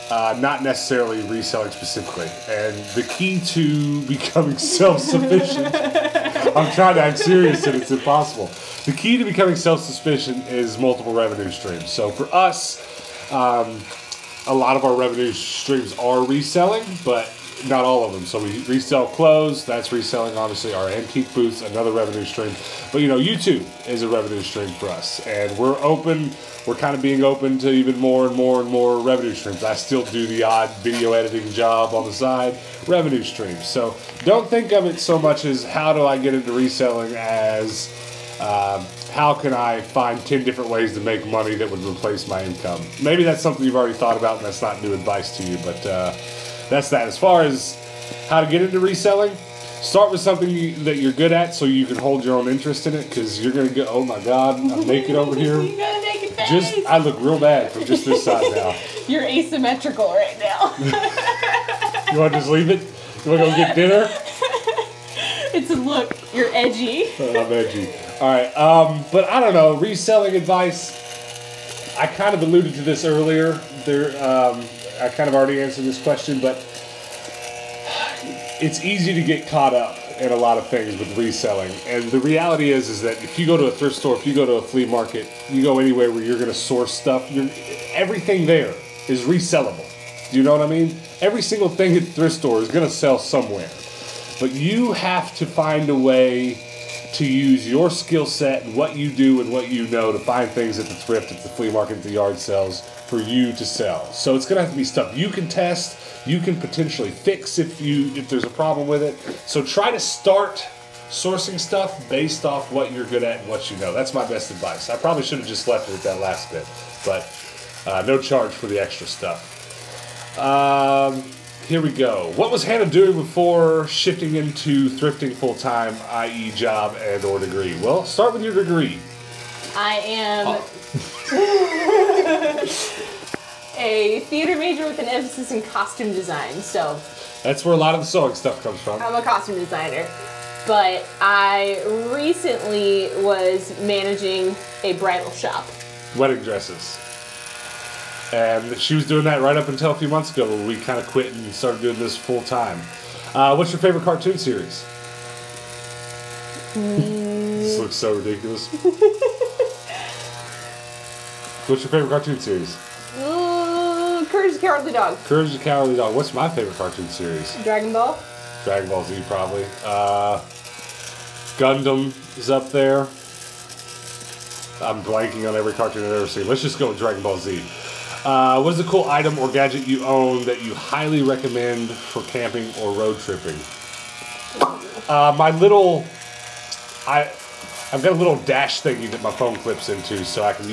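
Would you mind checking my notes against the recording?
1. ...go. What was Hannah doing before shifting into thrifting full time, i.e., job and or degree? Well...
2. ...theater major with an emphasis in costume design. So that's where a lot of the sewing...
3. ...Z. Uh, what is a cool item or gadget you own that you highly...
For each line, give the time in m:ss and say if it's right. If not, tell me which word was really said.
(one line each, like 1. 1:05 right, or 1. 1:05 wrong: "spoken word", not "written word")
1. 2:01 right
2. 2:14 right
3. 2:57 right.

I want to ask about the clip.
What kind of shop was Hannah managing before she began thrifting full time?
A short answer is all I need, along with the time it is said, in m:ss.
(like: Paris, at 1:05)
A bridal shop, at 2:24.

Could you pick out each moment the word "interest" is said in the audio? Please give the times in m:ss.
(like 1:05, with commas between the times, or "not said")
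0:52.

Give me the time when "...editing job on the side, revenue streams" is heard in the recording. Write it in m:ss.
0:31.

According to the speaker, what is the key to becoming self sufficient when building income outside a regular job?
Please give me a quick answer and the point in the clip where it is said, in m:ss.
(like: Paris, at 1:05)
Multiple revenue streams, at 0:10.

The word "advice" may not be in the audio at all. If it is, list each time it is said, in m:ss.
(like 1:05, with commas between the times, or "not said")
0:44, 1:10, 1:54.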